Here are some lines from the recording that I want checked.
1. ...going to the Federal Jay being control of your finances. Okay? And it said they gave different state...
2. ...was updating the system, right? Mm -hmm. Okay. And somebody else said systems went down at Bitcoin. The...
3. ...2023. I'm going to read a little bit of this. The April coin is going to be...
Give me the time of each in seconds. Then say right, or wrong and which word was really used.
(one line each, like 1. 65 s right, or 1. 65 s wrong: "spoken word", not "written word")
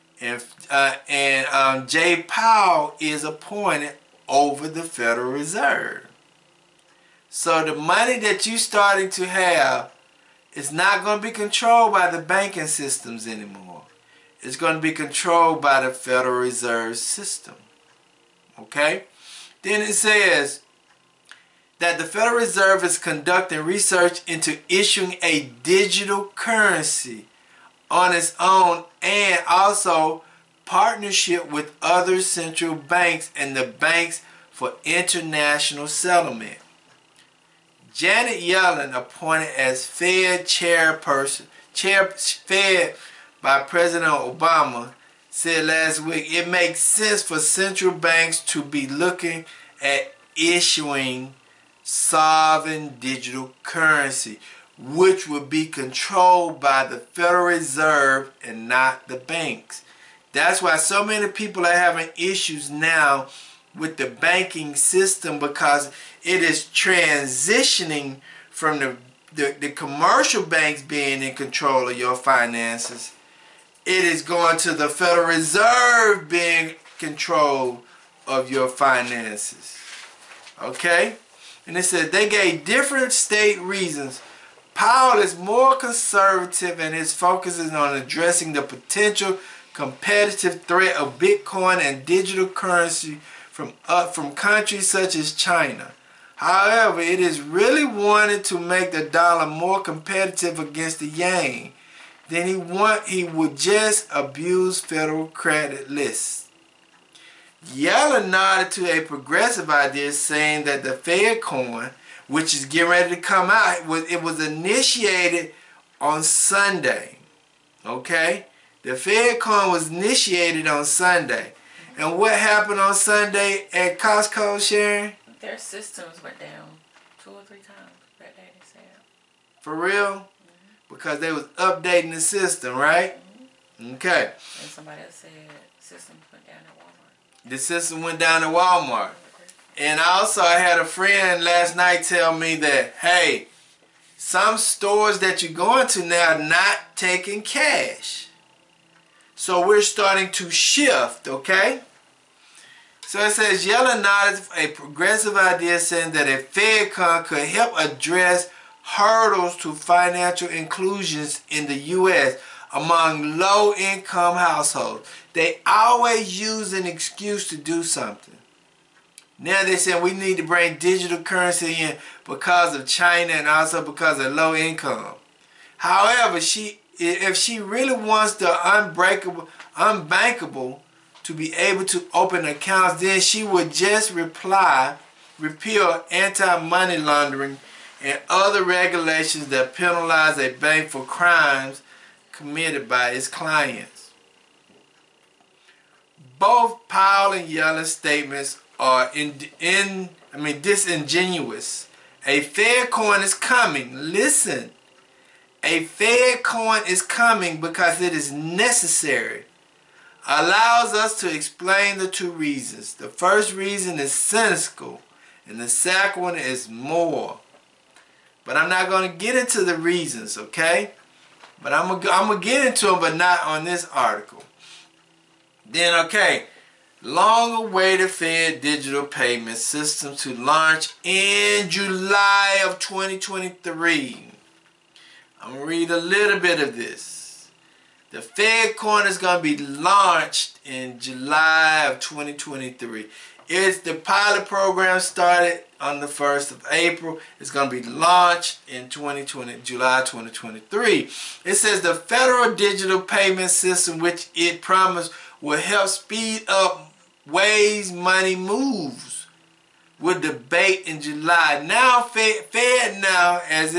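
1. 74 s wrong: "Reserve", not "Jay"
2. 131 s wrong: "Walmart", not "Bitcoin"
3. 232 s wrong: "Fed", not "April".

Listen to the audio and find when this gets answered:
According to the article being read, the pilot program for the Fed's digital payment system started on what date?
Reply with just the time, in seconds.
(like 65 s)
246 s.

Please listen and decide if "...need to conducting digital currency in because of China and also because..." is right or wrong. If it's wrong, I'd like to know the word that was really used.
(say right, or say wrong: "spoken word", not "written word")
wrong: "bring", not "conducting".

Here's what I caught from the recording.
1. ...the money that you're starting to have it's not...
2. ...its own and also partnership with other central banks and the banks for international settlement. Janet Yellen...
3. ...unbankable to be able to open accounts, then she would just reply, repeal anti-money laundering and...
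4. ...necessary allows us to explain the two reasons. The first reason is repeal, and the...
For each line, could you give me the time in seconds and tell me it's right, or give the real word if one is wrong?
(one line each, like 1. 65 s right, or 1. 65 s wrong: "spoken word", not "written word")
1. 7 s right
2. 28 s right
3. 179 s right
4. 208 s wrong: "cynical", not "repeal".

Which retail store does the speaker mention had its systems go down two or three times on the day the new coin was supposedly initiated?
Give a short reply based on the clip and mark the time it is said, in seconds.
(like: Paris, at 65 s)
Costco, at 123 s.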